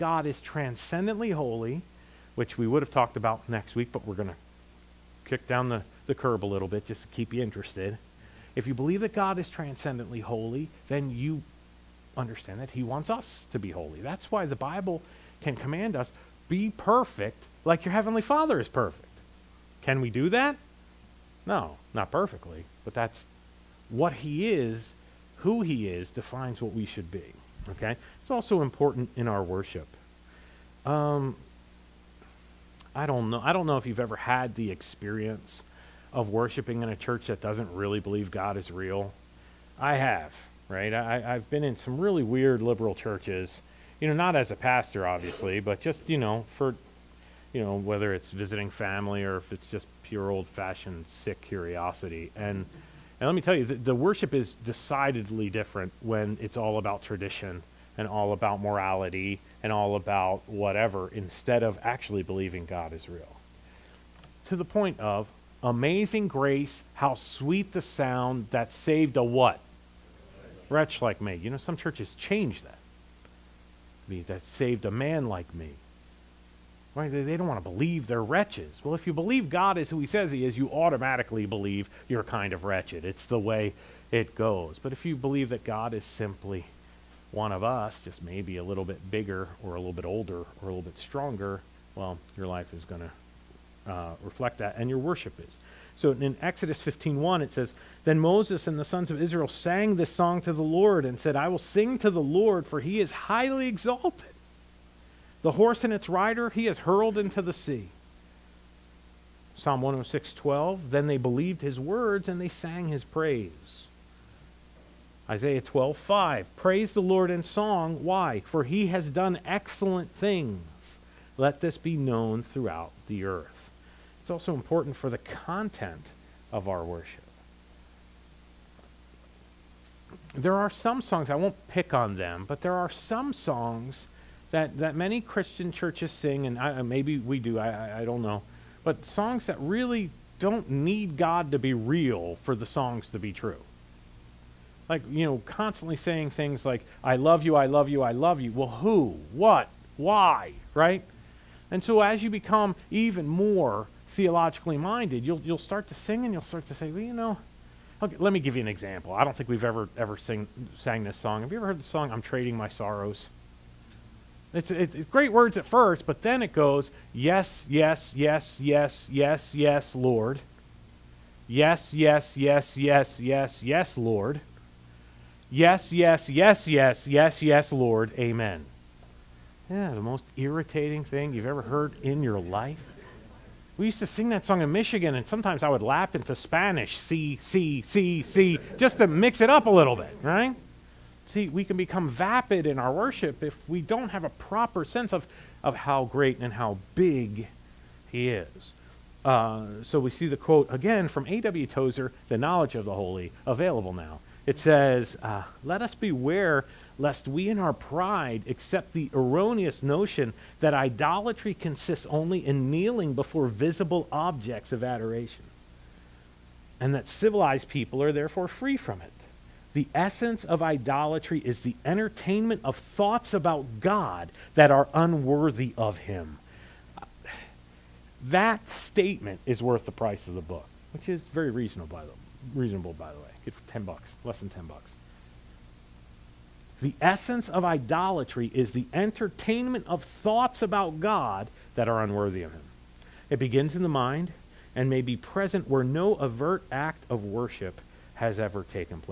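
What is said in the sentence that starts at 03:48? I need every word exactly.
That statement is worth the price of the book, which is very reasonable by the reasonable by the way.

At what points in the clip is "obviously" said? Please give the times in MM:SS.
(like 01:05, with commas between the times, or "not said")
00:45.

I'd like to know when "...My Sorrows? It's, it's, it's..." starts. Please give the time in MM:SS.
02:42.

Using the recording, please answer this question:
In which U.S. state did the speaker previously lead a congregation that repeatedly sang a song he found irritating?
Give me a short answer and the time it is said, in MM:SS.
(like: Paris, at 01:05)
Michigan, at 03:04.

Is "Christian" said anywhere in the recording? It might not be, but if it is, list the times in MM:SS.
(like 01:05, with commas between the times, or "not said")
02:15.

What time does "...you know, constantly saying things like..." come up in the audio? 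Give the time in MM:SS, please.
02:25.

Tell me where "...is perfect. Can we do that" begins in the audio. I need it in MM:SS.
00:18.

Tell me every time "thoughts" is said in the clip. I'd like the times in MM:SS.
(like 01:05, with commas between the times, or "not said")
03:42, 04:00.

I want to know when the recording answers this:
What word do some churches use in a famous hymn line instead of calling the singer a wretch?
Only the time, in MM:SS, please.
01:14.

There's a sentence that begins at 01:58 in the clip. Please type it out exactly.
For he has done excellent things.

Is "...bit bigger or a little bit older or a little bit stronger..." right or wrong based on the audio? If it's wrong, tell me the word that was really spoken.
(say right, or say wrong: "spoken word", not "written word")
right.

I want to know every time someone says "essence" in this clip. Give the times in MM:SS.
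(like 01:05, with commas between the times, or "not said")
03:39, 03:57.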